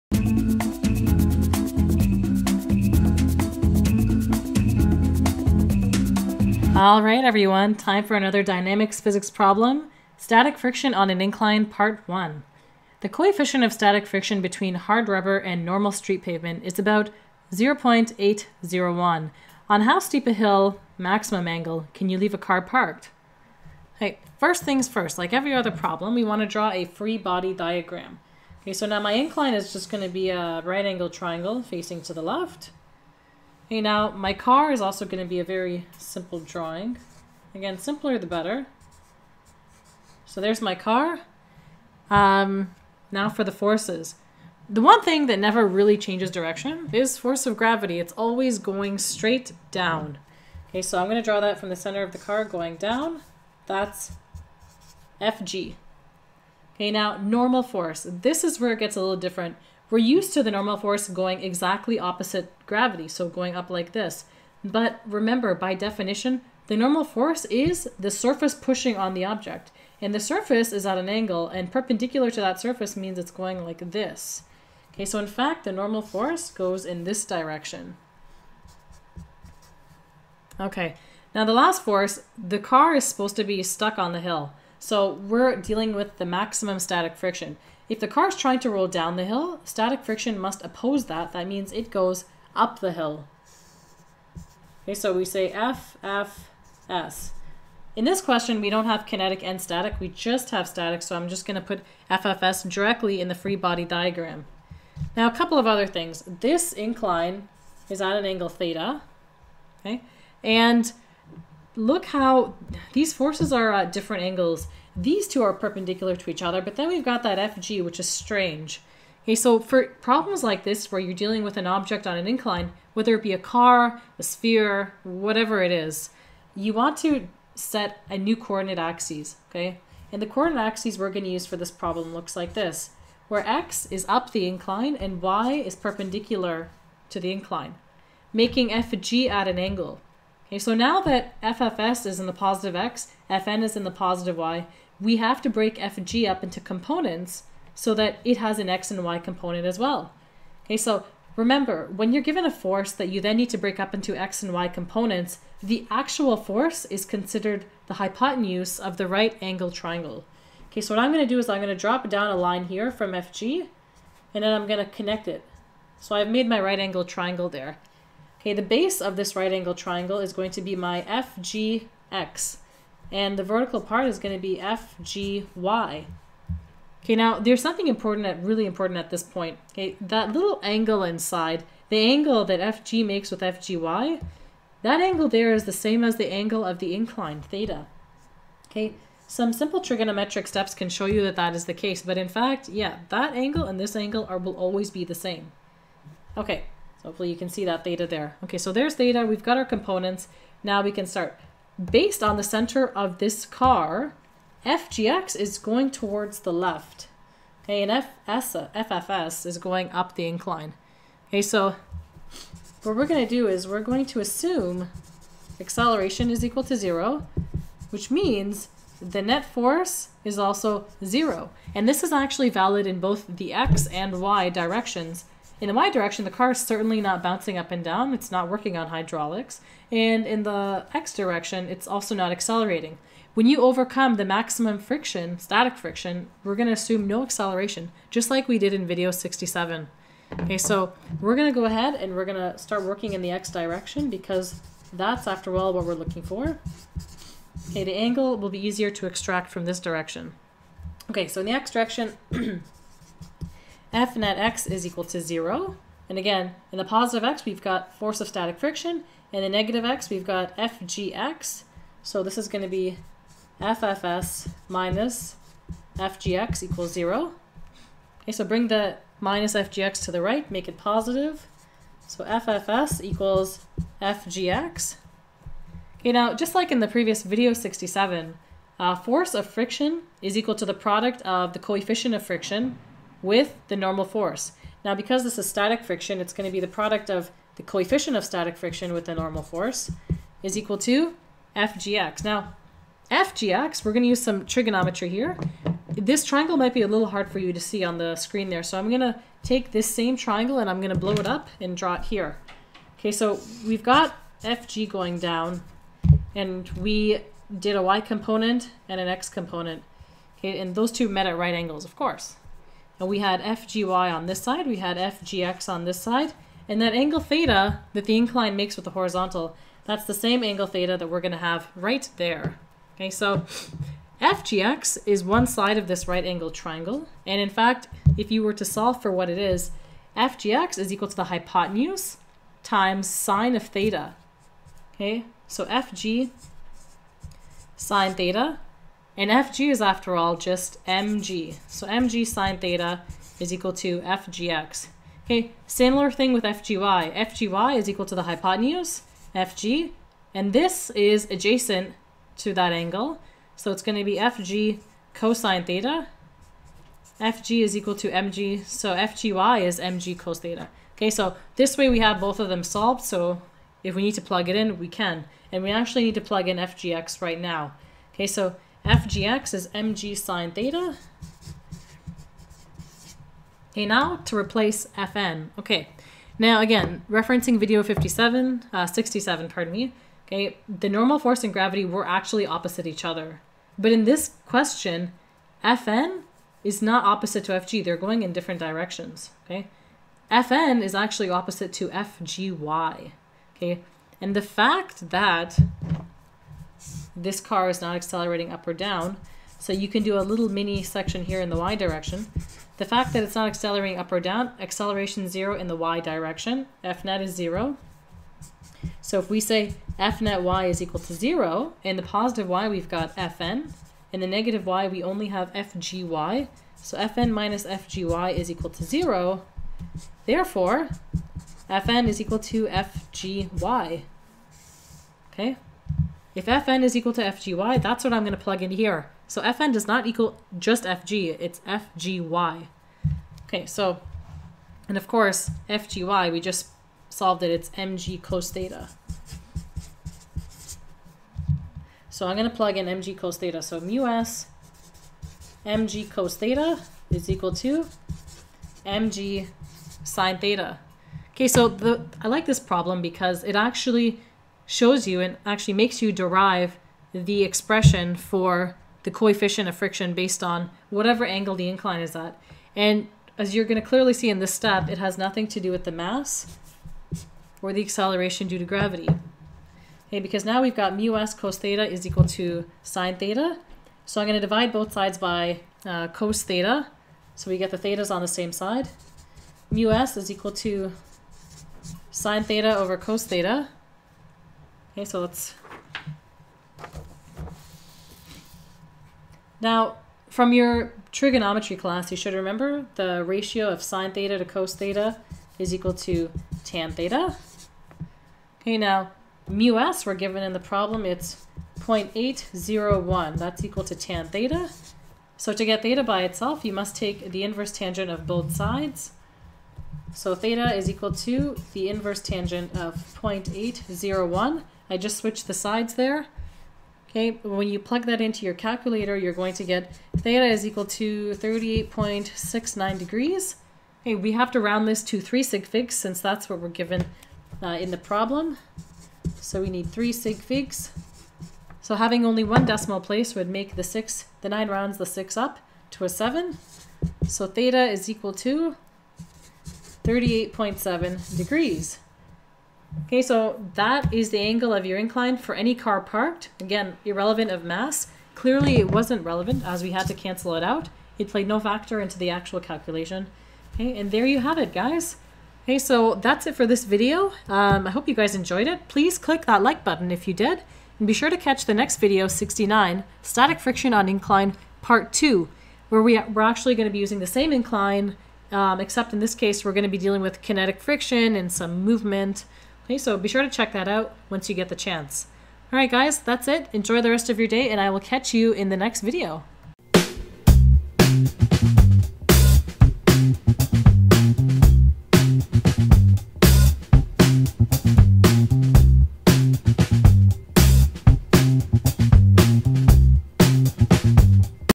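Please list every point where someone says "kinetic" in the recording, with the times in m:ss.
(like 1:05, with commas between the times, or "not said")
1:39, 9:30.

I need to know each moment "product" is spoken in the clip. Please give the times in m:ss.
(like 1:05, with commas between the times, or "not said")
4:40, 4:46.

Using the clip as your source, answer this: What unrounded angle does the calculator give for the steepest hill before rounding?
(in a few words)
38.69 degrees.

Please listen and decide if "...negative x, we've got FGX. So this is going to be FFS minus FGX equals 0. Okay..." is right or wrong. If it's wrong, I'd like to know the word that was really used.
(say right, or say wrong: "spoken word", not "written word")
right.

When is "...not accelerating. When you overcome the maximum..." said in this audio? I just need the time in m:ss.
3:52.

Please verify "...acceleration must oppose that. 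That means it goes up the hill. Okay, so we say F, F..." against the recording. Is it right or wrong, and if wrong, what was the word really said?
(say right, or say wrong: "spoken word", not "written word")
wrong: "friction", not "acceleration".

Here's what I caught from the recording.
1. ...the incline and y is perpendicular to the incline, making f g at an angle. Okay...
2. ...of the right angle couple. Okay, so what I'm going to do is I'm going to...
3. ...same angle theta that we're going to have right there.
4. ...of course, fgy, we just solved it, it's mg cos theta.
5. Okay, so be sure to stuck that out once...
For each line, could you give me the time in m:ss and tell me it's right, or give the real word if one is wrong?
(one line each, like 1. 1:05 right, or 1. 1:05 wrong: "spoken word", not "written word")
1. 2:14 right
2. 2:38 wrong: "triangle", not "couple"
3. 5:20 right
4. 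7:14 right
5. 9:32 wrong: "check", not "stuck".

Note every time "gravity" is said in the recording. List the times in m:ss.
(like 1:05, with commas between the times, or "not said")
0:47, 1:02, 6:21, 7:48.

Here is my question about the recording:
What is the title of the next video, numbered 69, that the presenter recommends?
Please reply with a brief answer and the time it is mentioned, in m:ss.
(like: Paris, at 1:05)
Static Friction on Incline Part 2, at 9:23.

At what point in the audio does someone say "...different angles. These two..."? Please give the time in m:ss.
1:53.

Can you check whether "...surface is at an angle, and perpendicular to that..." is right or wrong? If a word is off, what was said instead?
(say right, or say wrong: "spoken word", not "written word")
right.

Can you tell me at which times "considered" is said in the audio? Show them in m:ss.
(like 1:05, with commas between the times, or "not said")
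2:37.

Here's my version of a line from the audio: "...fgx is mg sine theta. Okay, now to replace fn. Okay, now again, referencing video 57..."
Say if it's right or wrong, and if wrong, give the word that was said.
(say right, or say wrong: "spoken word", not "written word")
right.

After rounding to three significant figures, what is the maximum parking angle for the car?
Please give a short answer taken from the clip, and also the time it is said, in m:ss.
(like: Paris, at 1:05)
38.7 degrees, at 9:00.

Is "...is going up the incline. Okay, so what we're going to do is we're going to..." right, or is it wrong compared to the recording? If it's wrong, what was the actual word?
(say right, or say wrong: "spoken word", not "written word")
right.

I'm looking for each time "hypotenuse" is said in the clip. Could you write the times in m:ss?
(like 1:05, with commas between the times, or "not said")
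2:37, 5:31, 5:48.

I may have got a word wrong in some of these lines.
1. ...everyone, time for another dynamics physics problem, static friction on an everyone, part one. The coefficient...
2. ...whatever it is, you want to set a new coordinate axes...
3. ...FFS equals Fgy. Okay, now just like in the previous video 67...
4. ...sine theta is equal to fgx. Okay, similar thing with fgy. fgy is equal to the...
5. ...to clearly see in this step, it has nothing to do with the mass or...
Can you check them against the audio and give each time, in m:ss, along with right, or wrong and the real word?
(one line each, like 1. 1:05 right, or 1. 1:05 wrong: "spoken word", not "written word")
1. 0:07 wrong: "incline", not "everyone"
2. 2:05 right
3. 4:32 wrong: "FGX", not "Fgy"
4. 5:42 right
5. 7:43 right.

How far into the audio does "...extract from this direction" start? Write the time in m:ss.
4:09.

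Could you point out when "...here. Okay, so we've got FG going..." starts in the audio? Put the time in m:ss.
5:02.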